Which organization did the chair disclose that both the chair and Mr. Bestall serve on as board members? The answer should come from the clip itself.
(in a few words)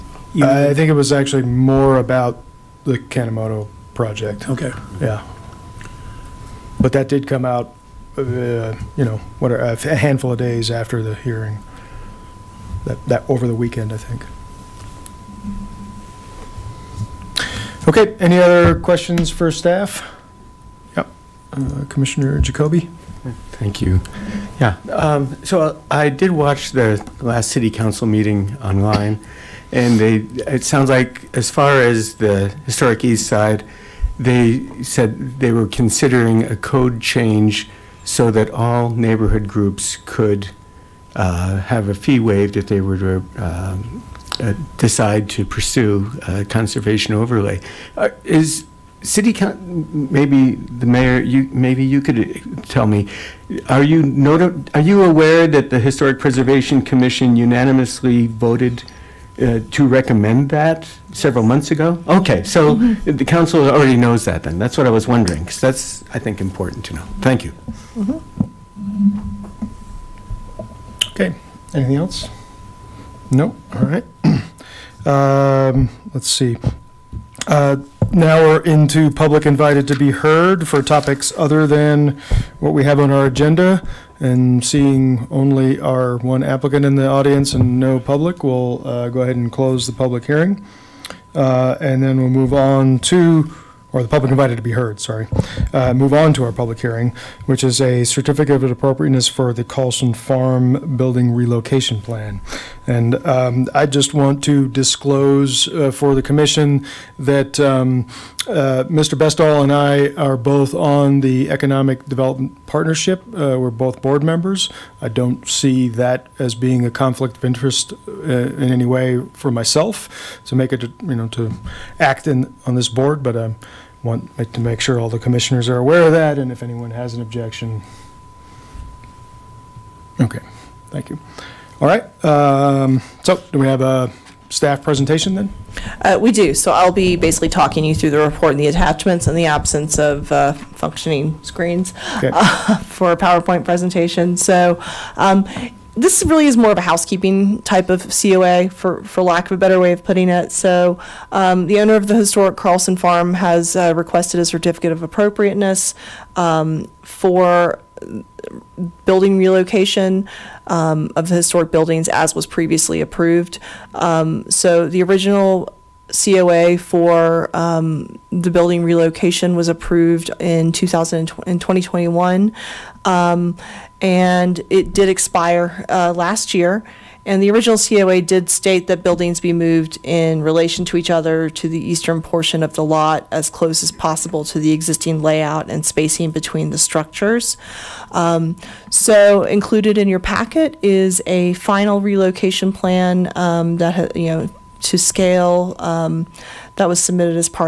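Economic Development Partnership.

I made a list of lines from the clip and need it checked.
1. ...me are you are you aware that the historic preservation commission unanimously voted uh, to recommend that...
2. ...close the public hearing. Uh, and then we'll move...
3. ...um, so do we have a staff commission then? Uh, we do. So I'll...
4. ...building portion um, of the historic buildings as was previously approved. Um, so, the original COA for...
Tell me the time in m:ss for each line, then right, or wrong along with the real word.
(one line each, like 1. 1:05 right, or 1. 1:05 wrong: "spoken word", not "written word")
1. 0:52 right
2. 1:29 right
3. 2:12 wrong: "presentation", not "commission"
4. 2:39 wrong: "relocation", not "portion".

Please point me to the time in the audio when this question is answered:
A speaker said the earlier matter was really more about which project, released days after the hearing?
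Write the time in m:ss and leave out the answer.
0:03.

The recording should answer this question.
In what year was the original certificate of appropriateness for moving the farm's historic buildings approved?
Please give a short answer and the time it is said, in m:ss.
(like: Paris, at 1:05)
2021, at 2:50.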